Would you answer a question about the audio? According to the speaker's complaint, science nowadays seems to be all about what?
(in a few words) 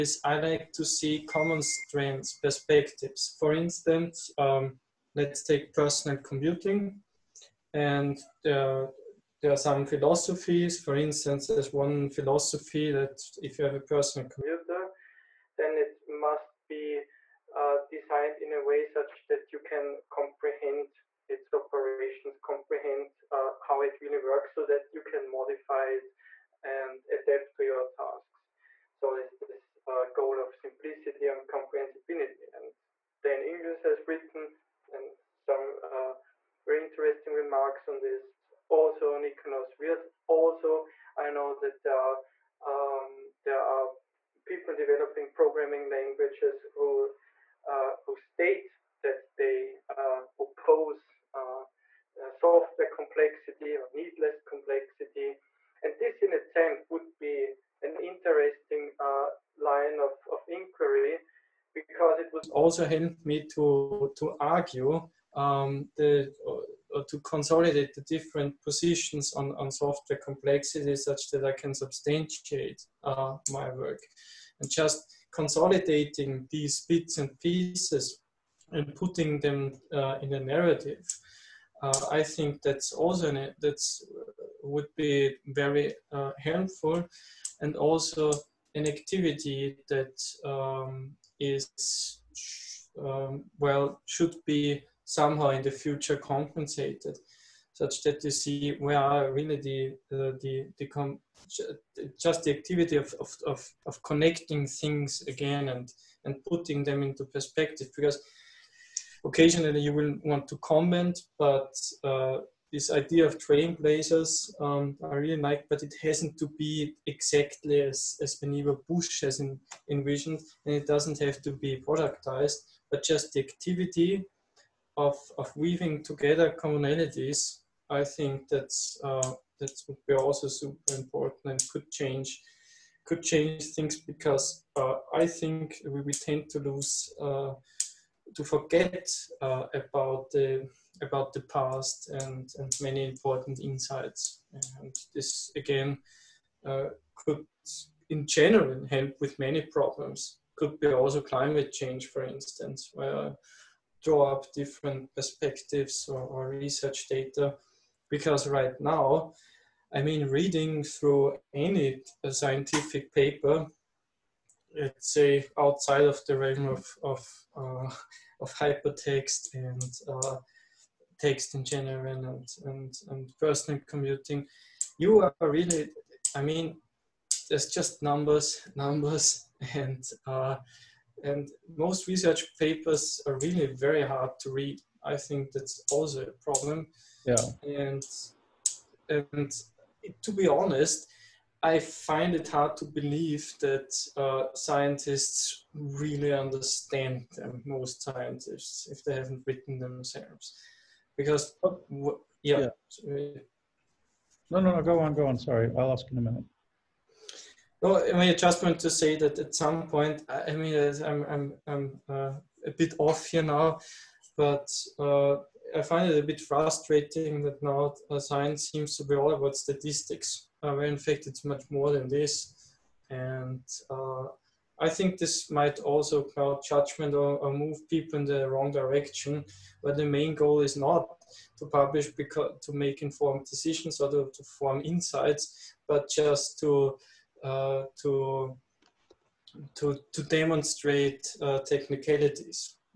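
Statistics.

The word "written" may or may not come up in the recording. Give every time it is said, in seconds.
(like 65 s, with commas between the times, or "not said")
34 s, 199 s.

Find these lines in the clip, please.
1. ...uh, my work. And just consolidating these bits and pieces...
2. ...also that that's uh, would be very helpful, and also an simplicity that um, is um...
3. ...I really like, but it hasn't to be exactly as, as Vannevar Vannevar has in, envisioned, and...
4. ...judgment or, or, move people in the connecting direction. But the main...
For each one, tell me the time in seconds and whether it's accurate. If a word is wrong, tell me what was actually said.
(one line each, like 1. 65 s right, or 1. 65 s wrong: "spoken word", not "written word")
1. 73 s right
2. 82 s wrong: "activity", not "simplicity"
3. 115 s wrong: "Bush", not "Vannevar"
4. 226 s wrong: "wrong", not "connecting".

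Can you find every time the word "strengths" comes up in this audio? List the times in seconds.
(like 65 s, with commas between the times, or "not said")
1 s.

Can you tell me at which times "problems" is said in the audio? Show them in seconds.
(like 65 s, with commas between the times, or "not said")
149 s, 186 s.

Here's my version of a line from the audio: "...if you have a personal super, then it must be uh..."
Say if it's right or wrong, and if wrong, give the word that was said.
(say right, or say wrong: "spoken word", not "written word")
wrong: "computer", not "super".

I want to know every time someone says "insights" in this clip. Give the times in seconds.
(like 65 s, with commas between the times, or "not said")
143 s, 234 s.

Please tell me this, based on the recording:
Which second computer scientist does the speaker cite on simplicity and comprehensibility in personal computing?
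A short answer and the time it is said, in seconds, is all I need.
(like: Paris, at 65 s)
Niklaus Wirth, at 39 s.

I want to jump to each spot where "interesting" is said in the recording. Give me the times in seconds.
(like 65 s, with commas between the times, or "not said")
36 s, 57 s.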